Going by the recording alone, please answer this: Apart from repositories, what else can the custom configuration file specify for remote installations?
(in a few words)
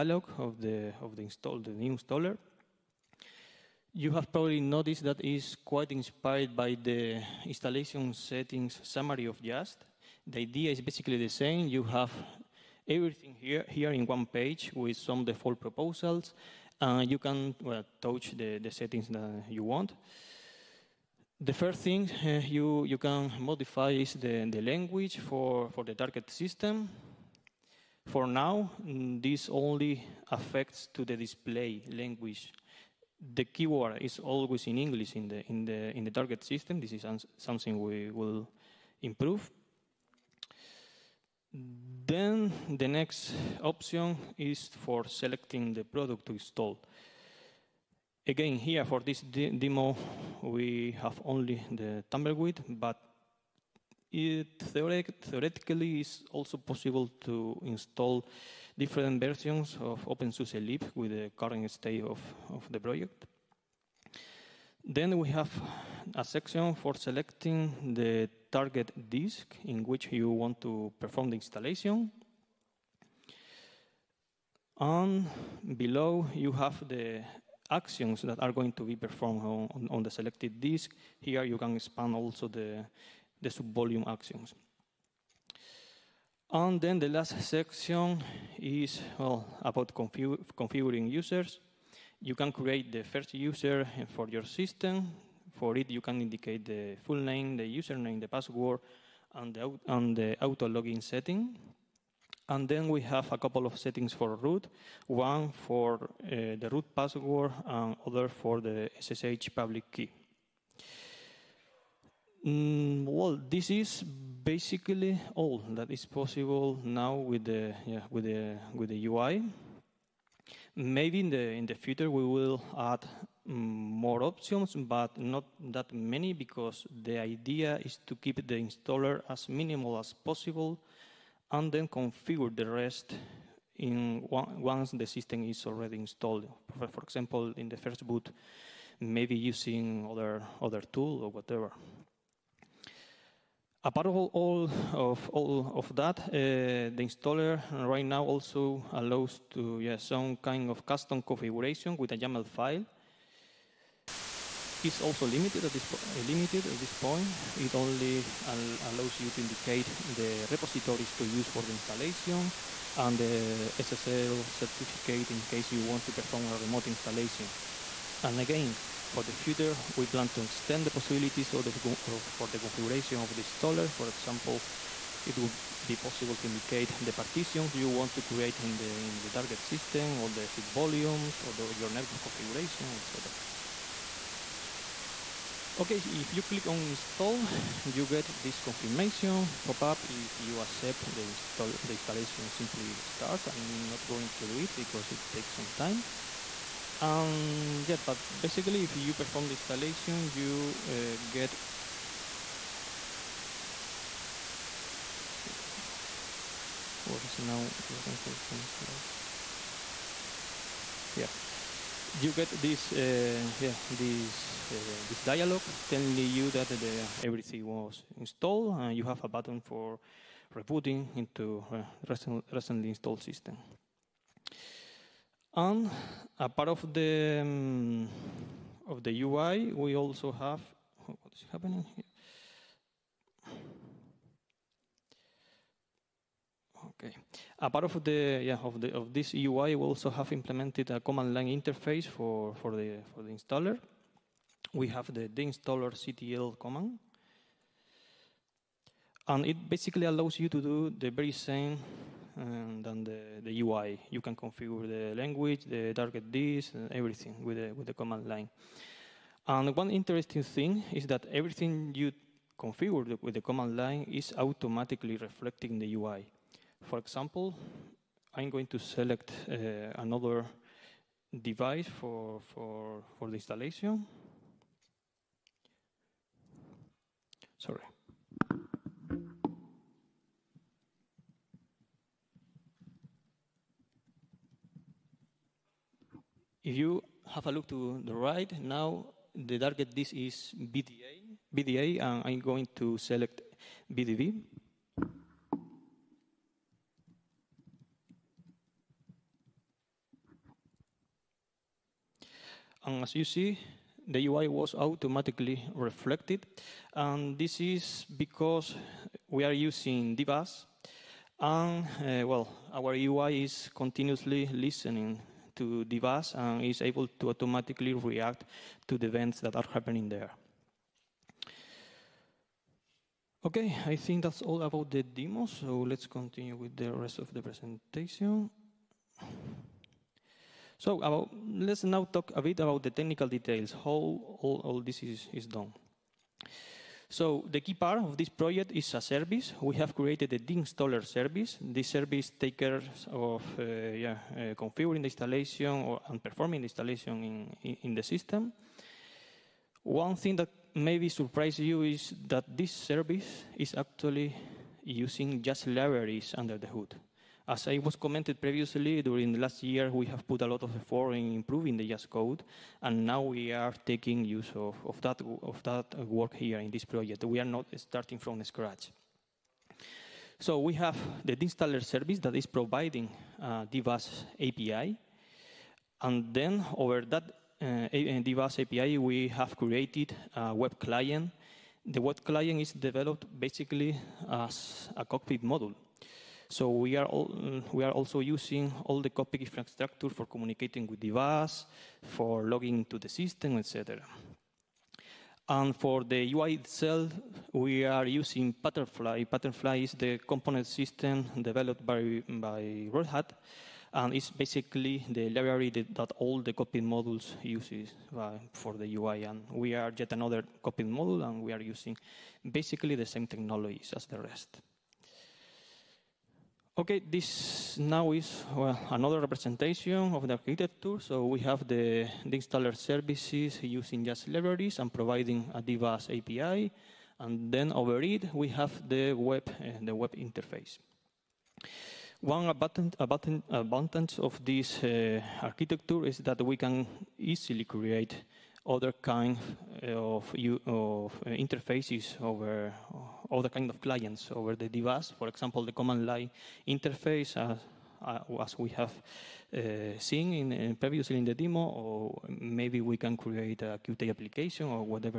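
SSL certificate.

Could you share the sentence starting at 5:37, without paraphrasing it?
So the key part of this project is a service.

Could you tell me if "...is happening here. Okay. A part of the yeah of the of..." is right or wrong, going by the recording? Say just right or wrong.
right.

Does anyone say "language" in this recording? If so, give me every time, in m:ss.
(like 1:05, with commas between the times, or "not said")
0:24, 0:31, 4:15.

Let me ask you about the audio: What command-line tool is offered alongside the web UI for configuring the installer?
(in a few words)
deinstaller ctl.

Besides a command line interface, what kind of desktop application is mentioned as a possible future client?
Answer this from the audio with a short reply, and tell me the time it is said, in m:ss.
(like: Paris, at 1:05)
Qt application, at 7:33.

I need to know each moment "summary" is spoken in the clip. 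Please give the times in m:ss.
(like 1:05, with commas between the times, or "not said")
0:08.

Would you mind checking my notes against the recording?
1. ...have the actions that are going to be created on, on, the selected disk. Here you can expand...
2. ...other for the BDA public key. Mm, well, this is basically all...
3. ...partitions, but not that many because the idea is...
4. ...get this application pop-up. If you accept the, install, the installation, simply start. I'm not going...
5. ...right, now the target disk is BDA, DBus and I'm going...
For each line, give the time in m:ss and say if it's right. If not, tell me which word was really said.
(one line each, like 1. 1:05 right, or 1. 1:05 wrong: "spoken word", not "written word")
1. 1:16 wrong: "performed", not "created"
2. 1:48 wrong: "SSH", not "BDA"
3. 2:04 wrong: "options", not "partitions"
4. 3:08 wrong: "confirmation", not "application"
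5. 4:48 wrong: "BDA", not "DBus".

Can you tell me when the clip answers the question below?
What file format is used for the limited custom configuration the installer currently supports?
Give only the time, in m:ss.
2:32.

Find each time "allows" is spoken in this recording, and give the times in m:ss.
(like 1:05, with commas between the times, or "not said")
2:28, 2:38, 4:10.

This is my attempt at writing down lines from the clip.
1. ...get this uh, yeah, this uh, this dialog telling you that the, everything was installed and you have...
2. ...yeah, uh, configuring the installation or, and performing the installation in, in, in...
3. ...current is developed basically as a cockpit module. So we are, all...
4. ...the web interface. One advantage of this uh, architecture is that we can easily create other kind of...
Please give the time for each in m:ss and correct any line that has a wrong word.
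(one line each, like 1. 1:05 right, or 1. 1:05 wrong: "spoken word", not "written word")
1. 3:32 right
2. 5:43 right
3. 6:22 wrong: "client", not "current"
4. 7:09 right.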